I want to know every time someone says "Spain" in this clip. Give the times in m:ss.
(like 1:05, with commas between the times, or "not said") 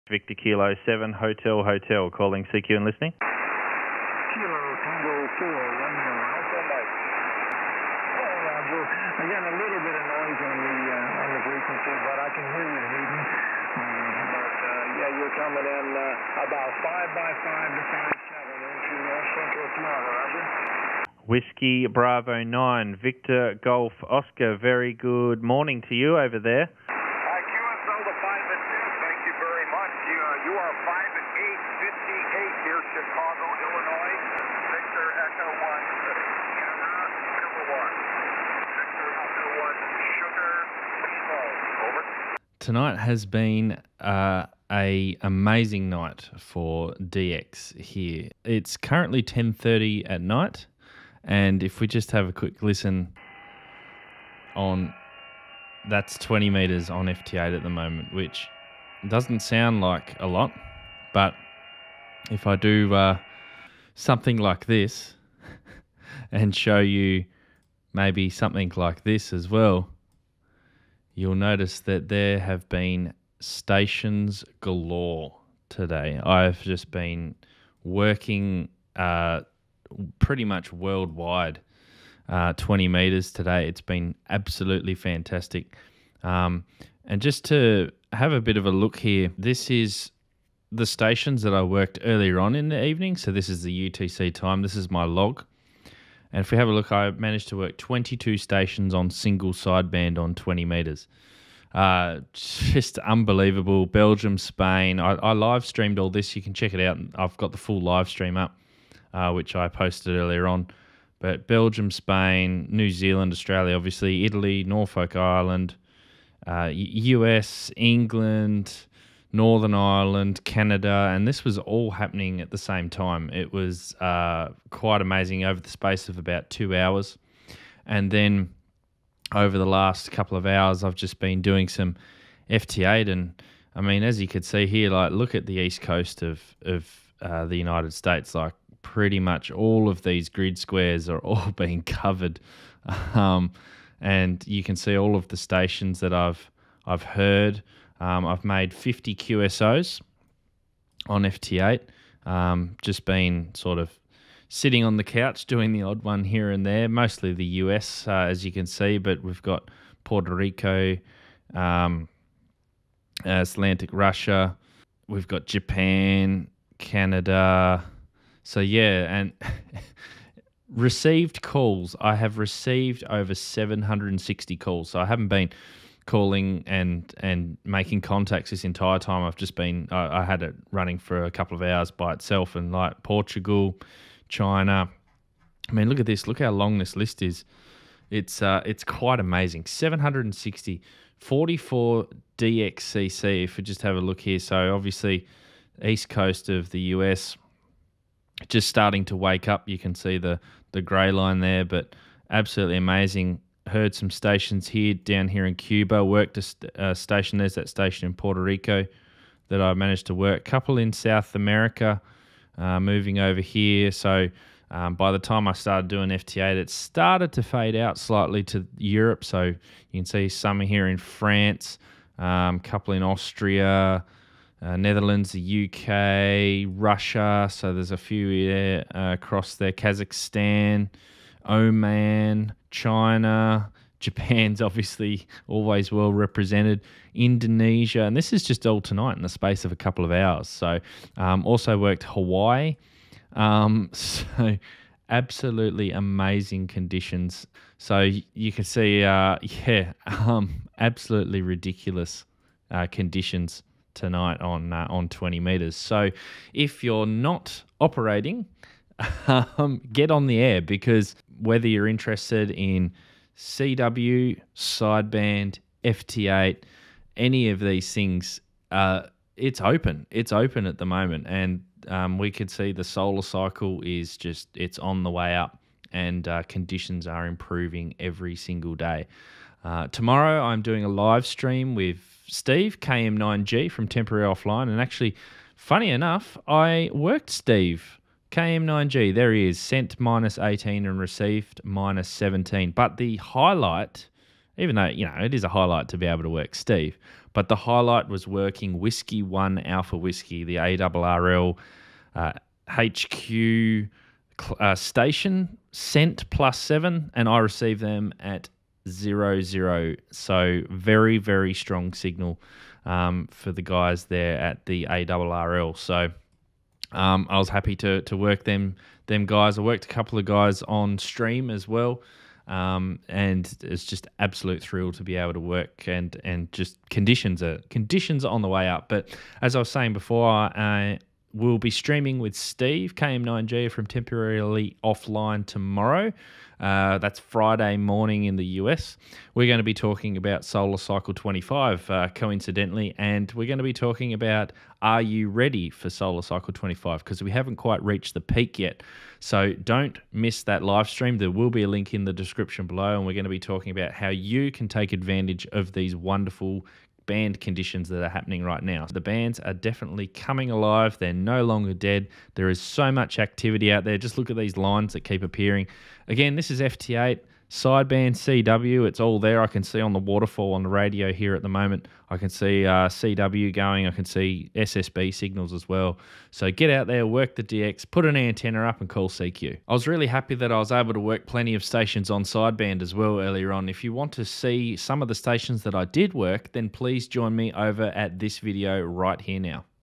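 1:44, 1:51.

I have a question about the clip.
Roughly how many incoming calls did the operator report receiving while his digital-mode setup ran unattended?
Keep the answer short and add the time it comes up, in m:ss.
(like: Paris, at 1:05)
760, at 2:53.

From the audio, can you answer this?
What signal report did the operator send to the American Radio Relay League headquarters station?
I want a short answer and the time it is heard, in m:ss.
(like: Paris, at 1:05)
+7, at 5:06.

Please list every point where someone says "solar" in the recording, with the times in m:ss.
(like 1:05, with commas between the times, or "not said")
4:32, 5:40, 5:45.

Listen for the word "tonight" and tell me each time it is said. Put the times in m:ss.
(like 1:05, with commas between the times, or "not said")
0:42, 3:58, 4:13.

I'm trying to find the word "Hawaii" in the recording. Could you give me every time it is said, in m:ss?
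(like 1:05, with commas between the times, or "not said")
4:02.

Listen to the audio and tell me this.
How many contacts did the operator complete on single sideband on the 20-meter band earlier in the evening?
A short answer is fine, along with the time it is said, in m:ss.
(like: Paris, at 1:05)
22, at 1:37.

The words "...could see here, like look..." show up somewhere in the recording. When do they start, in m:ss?
2:14.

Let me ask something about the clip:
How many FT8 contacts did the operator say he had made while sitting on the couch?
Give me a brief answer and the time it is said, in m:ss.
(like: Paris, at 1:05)
50, at 2:28.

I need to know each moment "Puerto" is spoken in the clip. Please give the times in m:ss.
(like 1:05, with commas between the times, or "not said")
2:40, 3:28.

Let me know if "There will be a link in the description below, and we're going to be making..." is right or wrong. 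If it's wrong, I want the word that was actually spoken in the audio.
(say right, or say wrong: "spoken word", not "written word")
wrong: "talking", not "making".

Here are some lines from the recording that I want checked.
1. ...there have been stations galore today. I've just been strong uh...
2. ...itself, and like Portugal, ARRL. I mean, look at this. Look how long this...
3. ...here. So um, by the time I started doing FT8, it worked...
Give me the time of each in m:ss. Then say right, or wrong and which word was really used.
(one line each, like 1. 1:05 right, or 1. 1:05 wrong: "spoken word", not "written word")
1. 1:12 wrong: "working", not "strong"
2. 3:02 wrong: "China", not "ARRL"
3. 3:33 wrong: "started", not "worked".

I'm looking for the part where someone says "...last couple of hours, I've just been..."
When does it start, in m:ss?
2:09.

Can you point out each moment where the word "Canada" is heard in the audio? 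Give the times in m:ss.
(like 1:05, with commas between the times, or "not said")
2:00, 2:46.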